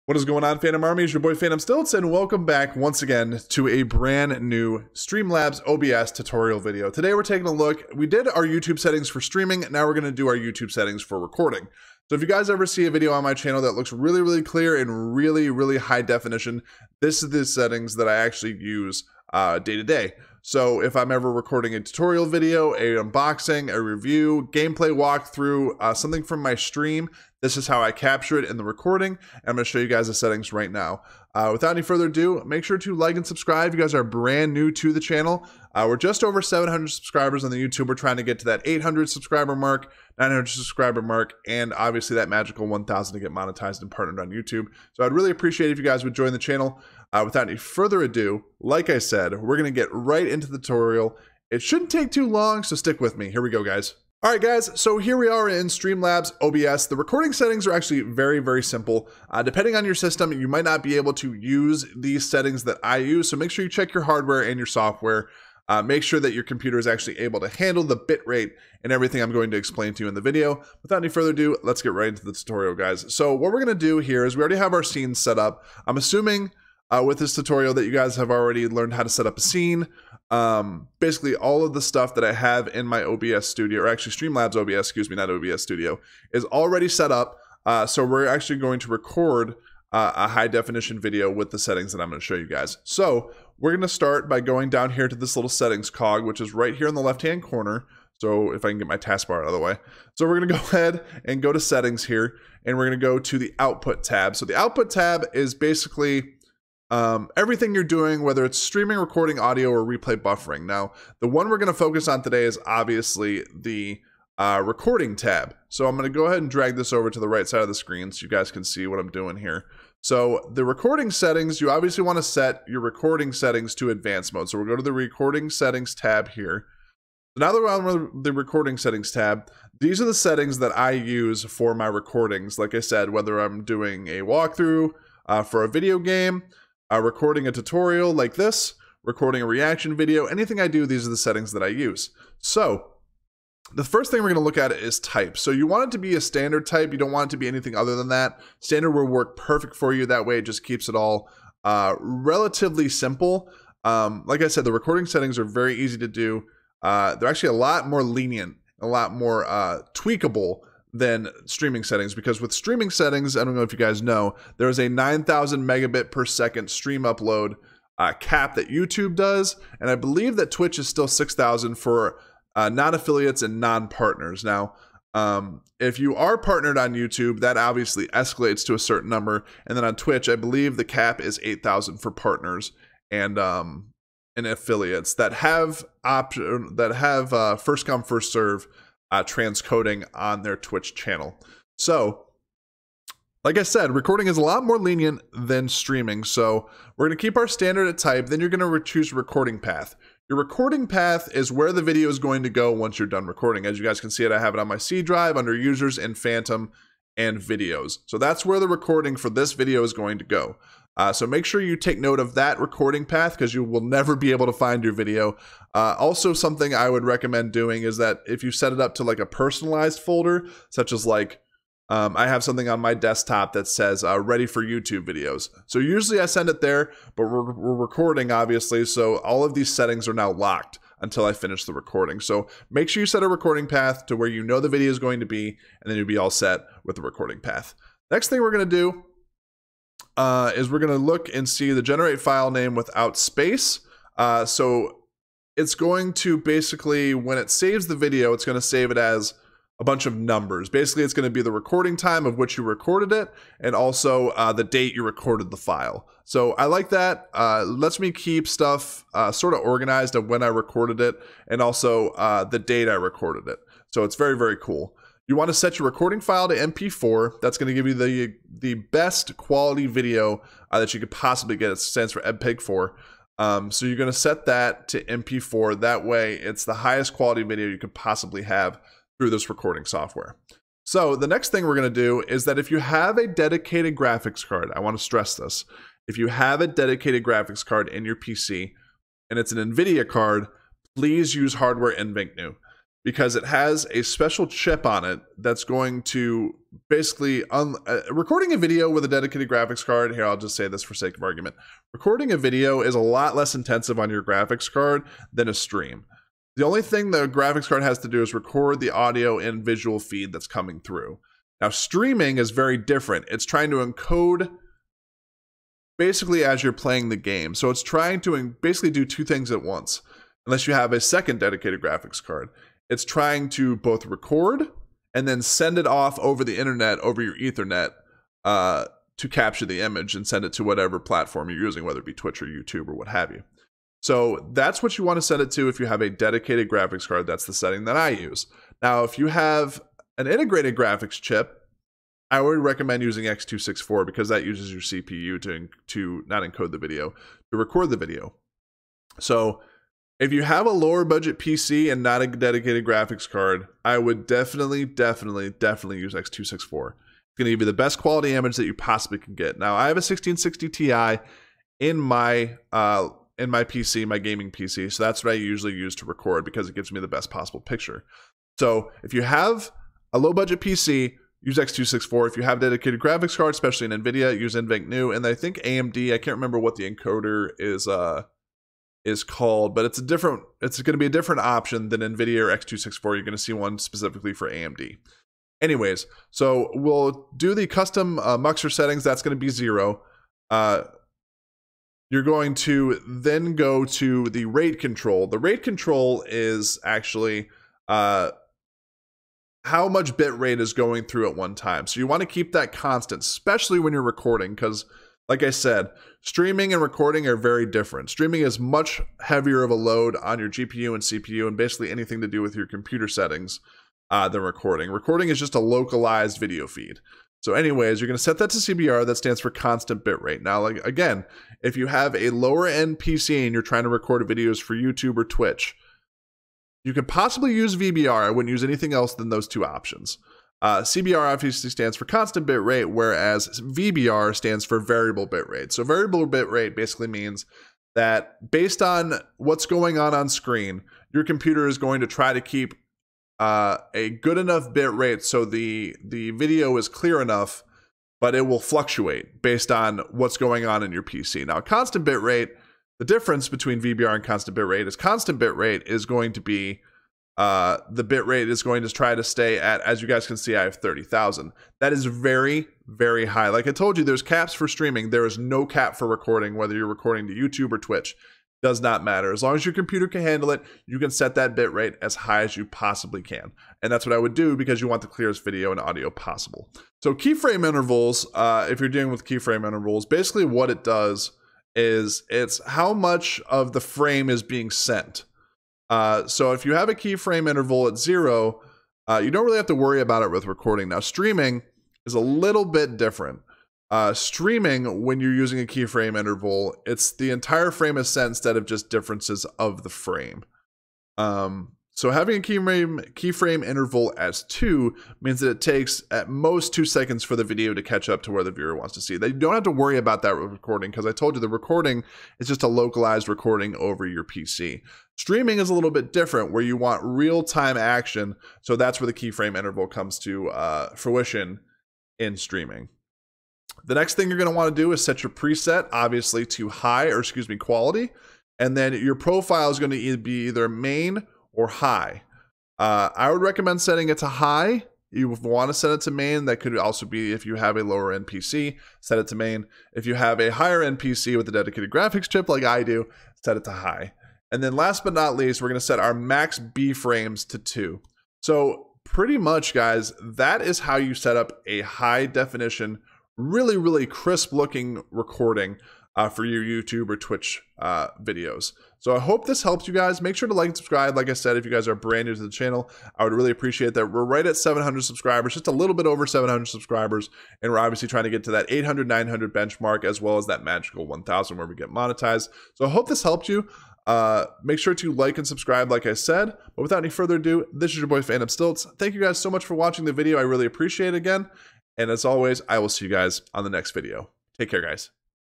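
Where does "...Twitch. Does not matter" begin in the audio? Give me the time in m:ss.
7:47.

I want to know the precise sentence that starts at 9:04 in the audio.
And then last but not least, we're going to set our max B frames to two.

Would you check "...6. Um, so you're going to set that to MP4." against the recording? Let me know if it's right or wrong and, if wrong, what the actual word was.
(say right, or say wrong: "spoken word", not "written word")
wrong: "4", not "6".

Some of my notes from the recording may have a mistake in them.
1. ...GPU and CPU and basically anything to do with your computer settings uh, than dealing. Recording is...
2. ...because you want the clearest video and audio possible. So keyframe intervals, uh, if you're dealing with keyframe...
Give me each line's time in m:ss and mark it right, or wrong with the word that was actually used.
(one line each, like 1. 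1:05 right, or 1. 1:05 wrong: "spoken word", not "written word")
1. 6:50 wrong: "recording", not "dealing"
2. 7:54 right.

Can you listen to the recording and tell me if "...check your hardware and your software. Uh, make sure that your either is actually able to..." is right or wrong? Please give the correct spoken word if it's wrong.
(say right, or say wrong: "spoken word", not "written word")
wrong: "computer", not "either".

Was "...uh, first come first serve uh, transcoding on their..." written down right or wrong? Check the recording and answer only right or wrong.
right.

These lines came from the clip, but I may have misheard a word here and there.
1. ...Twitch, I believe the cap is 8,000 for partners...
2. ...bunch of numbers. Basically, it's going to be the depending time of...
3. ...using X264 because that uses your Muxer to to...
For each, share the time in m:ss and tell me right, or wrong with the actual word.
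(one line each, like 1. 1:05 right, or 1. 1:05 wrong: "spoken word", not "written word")
1. 2:59 right
2. 4:09 wrong: "recording", not "depending"
3. 5:43 wrong: "CPU", not "Muxer".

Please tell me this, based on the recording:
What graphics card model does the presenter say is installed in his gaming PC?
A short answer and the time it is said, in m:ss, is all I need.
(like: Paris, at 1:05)
1660 Ti, at 6:00.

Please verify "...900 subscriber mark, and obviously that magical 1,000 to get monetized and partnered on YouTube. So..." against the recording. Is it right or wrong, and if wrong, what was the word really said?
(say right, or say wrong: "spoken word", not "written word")
right.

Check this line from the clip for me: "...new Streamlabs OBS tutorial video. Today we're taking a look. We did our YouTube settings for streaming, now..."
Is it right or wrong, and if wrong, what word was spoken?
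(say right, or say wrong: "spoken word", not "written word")
right.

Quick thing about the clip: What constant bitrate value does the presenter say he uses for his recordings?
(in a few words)
30,000.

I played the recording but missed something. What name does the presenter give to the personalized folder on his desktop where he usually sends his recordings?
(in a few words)
ready for YouTube videos.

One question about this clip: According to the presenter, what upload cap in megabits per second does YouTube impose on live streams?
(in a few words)
9,000.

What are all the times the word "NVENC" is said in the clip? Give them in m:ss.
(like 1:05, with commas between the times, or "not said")
4:51, 6:14.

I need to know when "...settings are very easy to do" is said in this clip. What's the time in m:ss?
2:35.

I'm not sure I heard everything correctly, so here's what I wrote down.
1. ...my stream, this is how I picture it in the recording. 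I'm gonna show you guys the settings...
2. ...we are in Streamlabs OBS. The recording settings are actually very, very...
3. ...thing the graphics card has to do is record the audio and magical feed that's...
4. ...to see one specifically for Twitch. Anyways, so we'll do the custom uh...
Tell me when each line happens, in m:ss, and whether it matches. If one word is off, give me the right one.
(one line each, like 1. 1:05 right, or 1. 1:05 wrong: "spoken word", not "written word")
1. 0:26 wrong: "capture", not "picture"
2. 0:55 right
3. 5:06 wrong: "visual", not "magical"
4. 6:23 wrong: "AMD", not "Twitch".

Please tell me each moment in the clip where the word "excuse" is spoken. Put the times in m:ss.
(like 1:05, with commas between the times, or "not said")
1:24, 8:47.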